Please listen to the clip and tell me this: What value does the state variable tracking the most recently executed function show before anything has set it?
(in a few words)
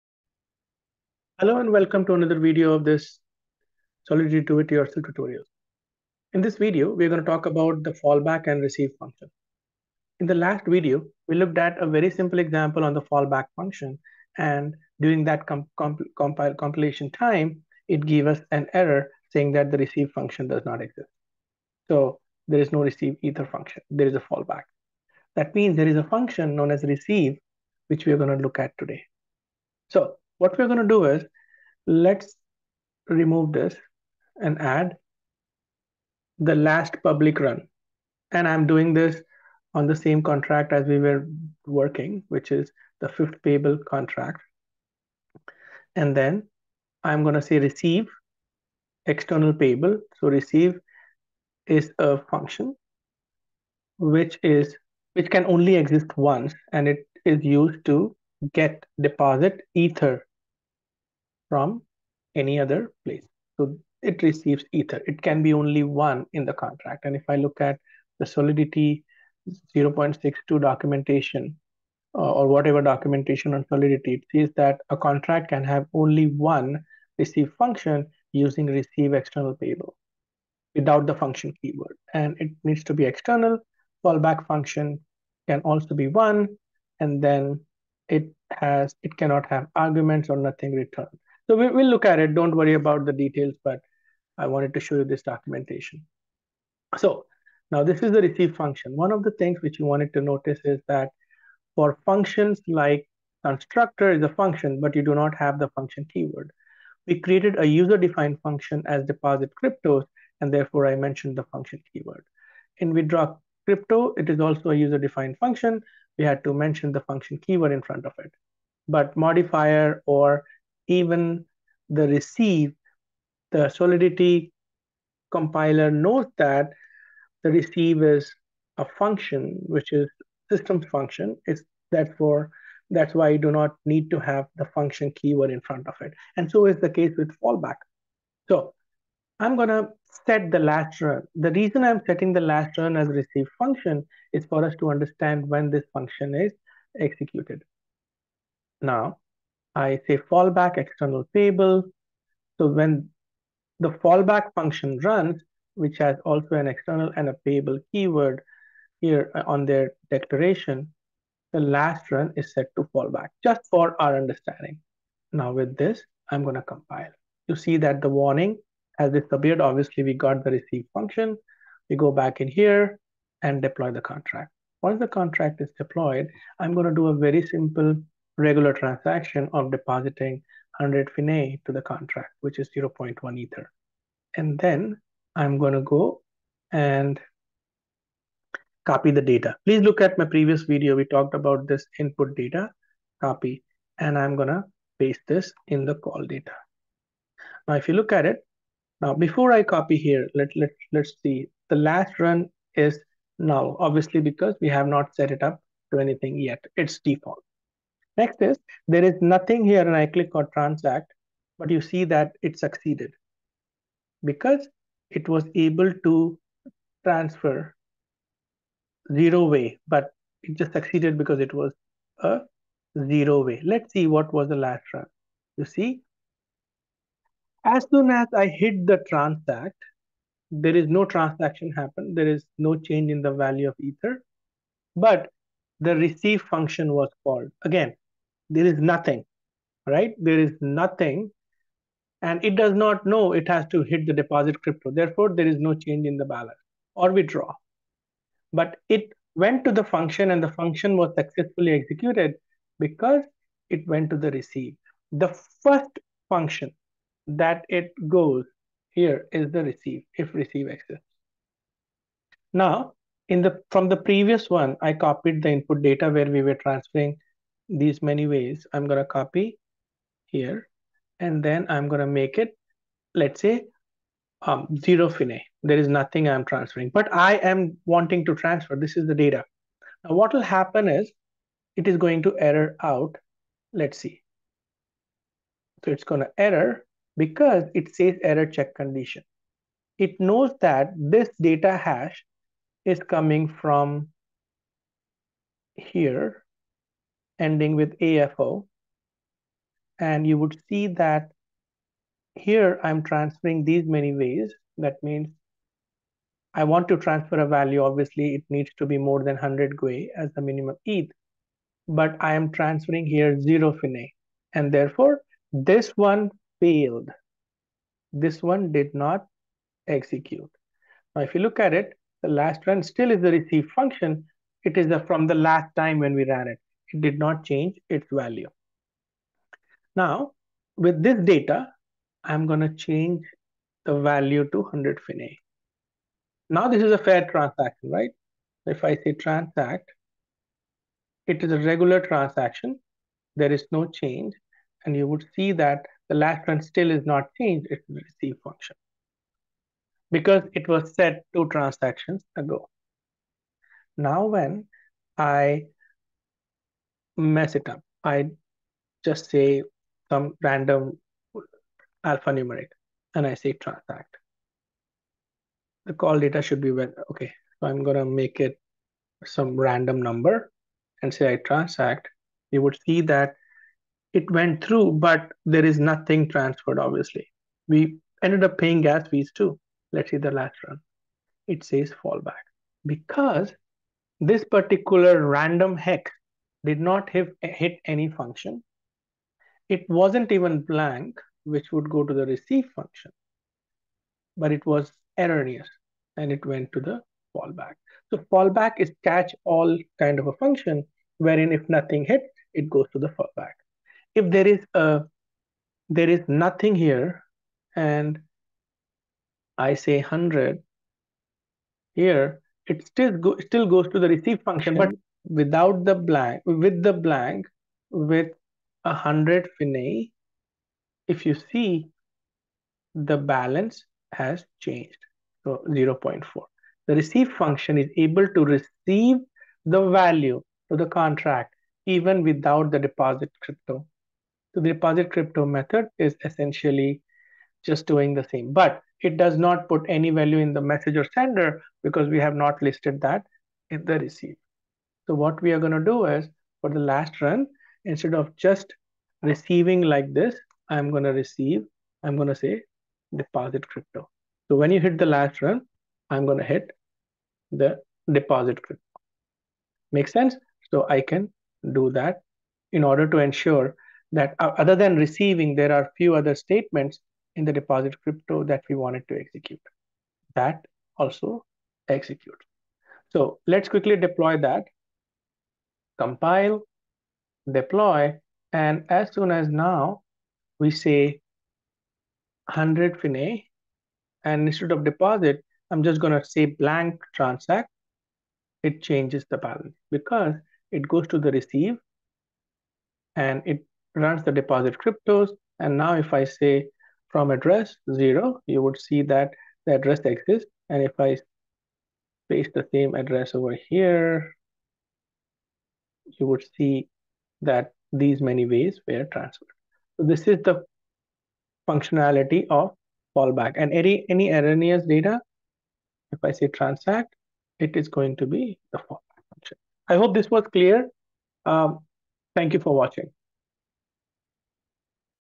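null.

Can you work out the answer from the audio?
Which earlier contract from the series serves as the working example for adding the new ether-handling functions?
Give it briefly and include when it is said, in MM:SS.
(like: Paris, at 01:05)
fifth payable contract, at 00:43.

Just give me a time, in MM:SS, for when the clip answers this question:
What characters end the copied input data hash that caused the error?
04:58.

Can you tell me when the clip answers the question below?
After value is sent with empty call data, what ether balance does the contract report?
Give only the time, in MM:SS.
07:05.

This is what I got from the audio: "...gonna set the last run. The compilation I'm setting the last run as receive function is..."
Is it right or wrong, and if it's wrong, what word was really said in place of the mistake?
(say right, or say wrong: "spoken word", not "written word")
wrong: "reason", not "compilation".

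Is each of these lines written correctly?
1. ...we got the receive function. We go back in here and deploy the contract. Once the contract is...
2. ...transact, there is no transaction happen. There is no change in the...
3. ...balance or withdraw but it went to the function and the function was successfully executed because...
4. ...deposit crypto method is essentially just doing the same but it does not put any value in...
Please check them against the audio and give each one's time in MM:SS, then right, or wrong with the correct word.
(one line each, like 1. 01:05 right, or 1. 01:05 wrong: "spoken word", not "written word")
1. 02:50 right
2. 03:49 right
3. 04:06 right
4. 07:14 right.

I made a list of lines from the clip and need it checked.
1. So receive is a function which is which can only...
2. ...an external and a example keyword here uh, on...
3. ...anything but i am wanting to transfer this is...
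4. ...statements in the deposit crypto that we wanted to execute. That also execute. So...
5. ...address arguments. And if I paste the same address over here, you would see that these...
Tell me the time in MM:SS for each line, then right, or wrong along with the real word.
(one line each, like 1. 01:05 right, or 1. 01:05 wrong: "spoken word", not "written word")
1. 00:50 right
2. 02:36 wrong: "payable", not "example"
3. 04:36 wrong: "transferring", not "anything"
4. 07:46 right
5. 08:19 wrong: "exists", not "arguments".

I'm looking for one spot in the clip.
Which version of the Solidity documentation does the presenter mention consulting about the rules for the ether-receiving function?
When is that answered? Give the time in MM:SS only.
01:09.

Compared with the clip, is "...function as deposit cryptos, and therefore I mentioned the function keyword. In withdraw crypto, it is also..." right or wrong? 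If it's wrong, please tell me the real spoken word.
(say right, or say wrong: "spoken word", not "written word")
right.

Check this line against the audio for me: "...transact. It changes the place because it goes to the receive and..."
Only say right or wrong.
wrong.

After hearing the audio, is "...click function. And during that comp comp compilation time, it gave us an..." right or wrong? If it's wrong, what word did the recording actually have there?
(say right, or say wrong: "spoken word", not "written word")
wrong: "fallback", not "click".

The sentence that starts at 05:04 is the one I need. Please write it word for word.
That means I want to transfer a value.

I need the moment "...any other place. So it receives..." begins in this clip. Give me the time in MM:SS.
01:02.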